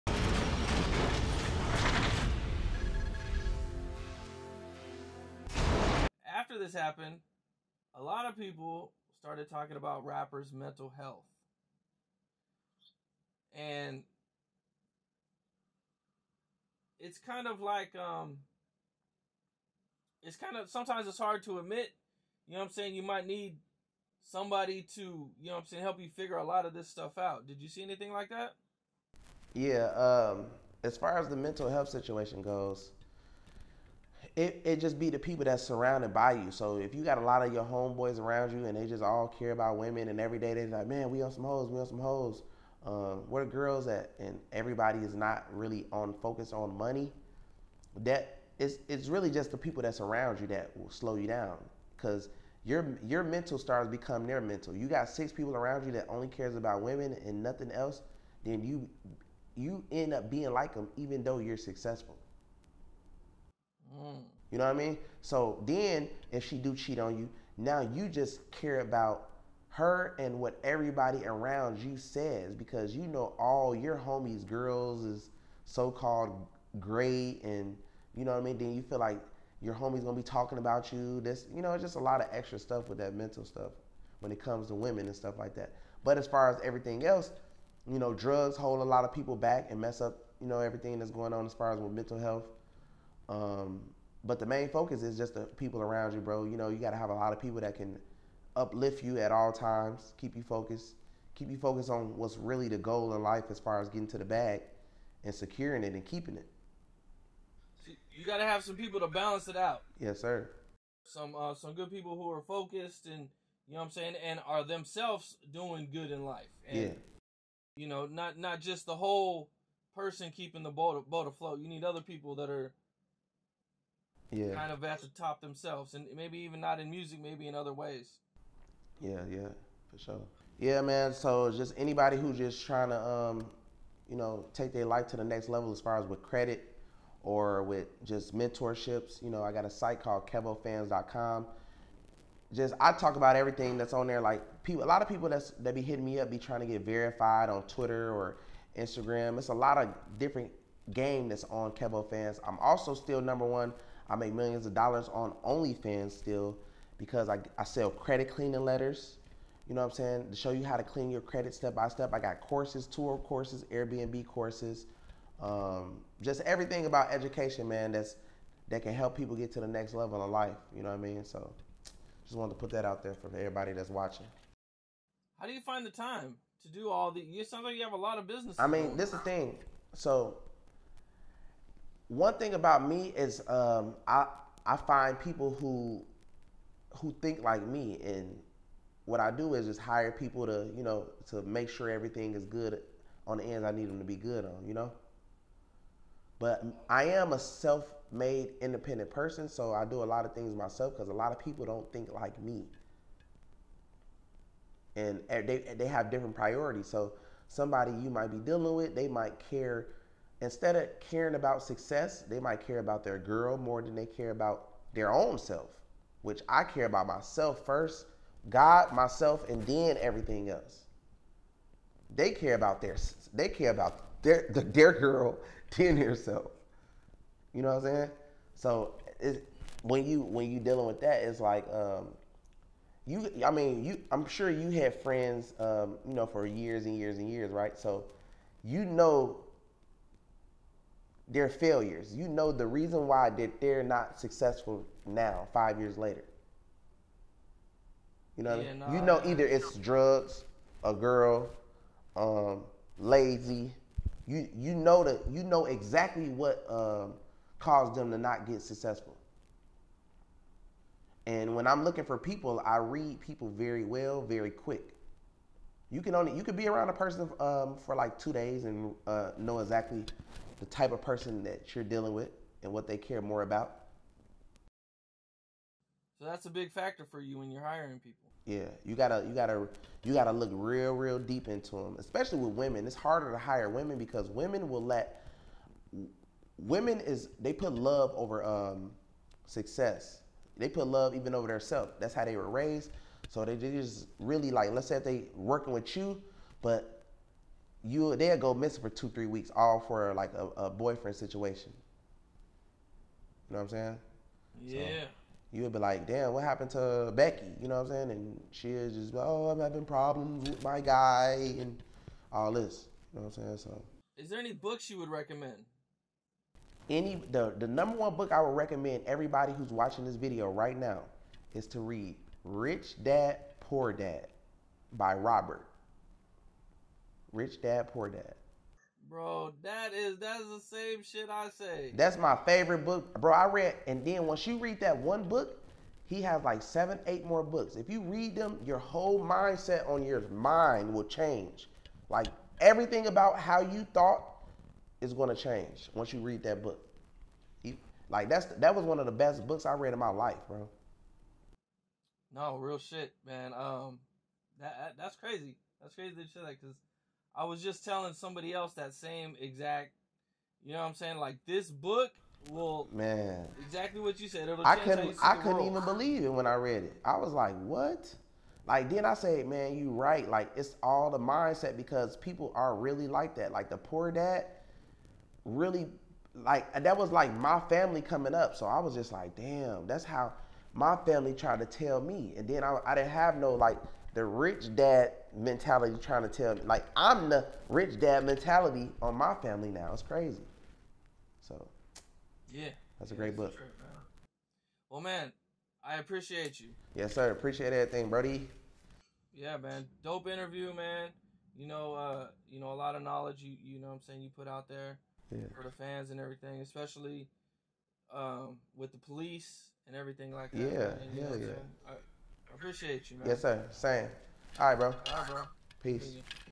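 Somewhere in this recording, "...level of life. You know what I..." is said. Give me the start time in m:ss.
2:49.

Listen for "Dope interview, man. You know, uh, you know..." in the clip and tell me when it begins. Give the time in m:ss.
6:40.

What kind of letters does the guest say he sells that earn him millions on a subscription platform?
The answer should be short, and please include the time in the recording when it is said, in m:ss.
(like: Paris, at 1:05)
Credit cleaning letters, at 2:37.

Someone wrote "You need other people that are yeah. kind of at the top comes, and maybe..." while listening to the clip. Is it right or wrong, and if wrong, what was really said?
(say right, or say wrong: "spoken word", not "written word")
wrong: "themselves", not "comes".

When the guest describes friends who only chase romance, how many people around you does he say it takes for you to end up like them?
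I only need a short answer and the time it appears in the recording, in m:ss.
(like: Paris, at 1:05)
6, at 0:55.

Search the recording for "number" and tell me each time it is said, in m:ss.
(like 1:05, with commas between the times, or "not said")
2:33, 5:17.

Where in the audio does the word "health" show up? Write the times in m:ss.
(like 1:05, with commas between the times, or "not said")
0:10, 0:31, 1:32.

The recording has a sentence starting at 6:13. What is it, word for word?
Like the poor dad really like that was like my family coming up.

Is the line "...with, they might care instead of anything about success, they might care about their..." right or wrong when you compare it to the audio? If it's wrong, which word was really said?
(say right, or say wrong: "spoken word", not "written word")
wrong: "caring", not "anything".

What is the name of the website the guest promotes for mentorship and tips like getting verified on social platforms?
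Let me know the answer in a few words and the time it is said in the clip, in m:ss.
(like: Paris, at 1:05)
KevoFans.com, at 2:20.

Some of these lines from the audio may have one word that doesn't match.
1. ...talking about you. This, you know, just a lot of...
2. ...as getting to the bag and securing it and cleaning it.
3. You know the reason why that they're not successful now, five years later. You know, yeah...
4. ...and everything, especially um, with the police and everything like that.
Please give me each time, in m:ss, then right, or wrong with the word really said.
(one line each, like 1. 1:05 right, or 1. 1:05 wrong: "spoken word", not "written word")
1. 1:20 right
2. 1:43 wrong: "keeping", not "cleaning"
3. 4:02 right
4. 6:46 right.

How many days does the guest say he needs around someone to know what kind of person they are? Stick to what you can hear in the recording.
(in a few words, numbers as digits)
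2.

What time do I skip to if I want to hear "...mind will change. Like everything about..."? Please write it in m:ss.
5:40.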